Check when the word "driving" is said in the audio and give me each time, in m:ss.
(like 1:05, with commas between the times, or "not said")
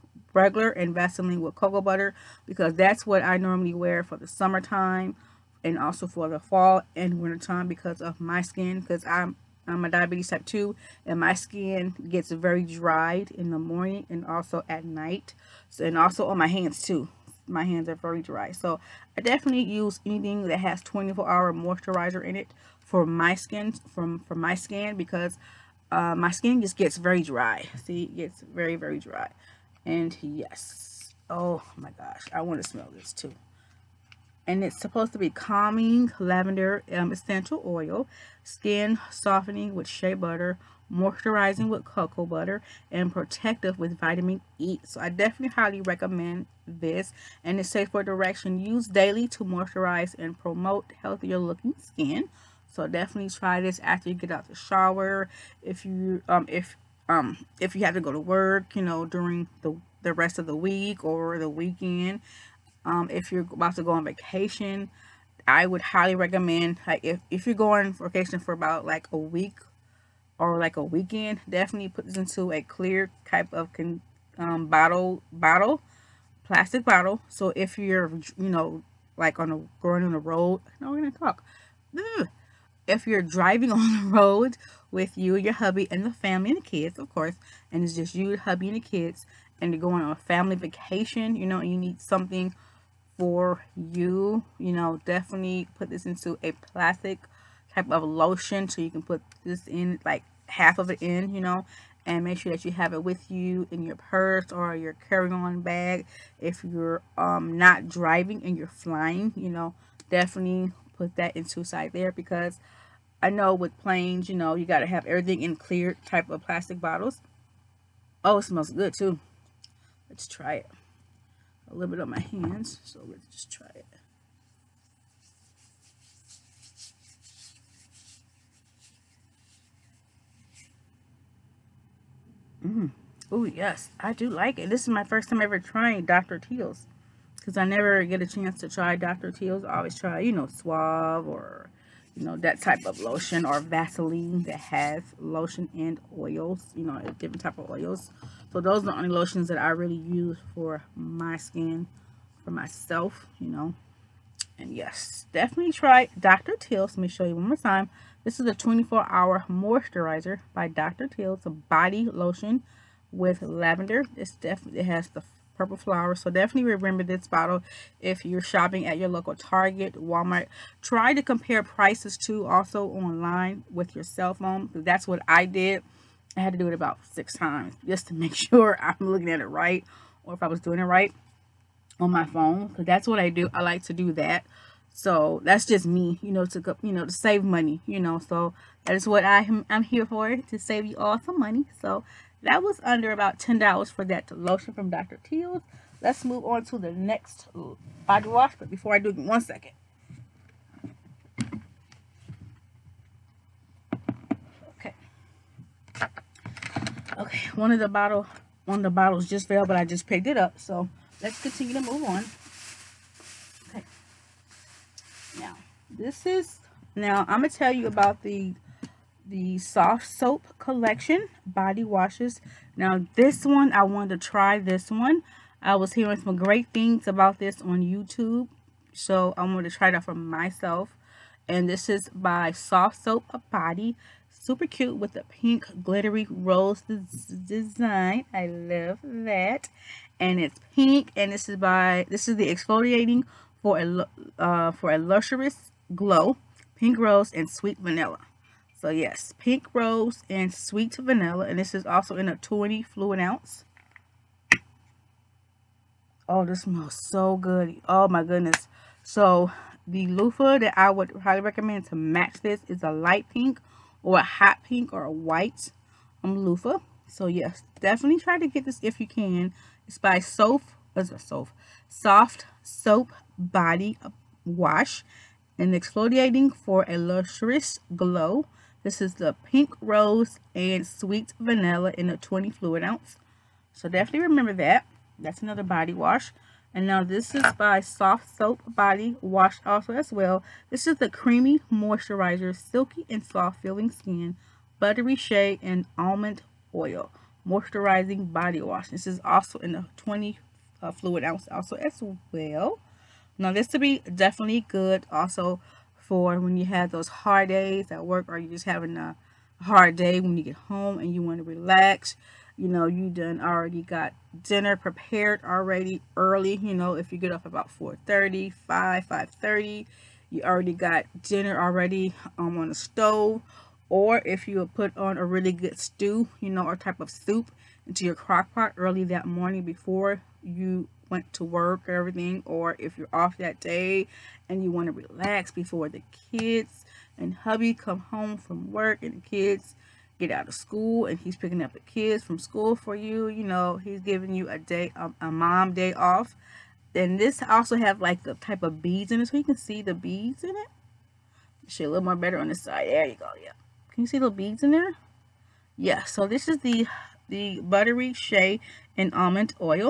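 1:23, 1:47.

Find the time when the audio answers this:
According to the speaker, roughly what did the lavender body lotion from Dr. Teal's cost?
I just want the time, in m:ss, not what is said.
3:12.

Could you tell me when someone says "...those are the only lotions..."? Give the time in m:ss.
2:28.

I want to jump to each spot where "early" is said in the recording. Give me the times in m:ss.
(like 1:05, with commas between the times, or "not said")
5:16, 5:28.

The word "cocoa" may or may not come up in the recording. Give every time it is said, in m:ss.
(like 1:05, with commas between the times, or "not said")
0:01, 0:41.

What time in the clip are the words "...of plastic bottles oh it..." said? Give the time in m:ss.
1:56.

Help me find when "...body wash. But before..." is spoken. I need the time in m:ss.
3:18.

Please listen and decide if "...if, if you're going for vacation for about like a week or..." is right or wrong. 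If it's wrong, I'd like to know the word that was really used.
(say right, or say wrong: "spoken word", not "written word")
right.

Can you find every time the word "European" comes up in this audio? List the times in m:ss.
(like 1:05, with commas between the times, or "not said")
not said.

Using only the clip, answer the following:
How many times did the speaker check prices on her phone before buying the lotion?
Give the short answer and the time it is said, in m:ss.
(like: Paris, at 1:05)
6, at 2:57.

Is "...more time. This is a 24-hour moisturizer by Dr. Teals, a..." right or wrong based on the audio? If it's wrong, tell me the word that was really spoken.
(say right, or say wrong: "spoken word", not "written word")
right.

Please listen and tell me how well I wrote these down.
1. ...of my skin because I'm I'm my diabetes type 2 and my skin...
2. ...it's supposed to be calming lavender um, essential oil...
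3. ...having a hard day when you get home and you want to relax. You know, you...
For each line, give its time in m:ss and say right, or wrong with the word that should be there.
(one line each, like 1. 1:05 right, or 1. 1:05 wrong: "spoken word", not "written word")
1. 0:08 right
2. 0:34 right
3. 5:08 right.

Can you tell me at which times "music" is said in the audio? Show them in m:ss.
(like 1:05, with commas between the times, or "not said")
not said.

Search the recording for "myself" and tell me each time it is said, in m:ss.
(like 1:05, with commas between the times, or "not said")
2:32, 3:50.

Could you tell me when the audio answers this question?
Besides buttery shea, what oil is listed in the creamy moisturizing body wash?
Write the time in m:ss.
4:55.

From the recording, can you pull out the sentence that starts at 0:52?
So definitely try this after you get out the shower.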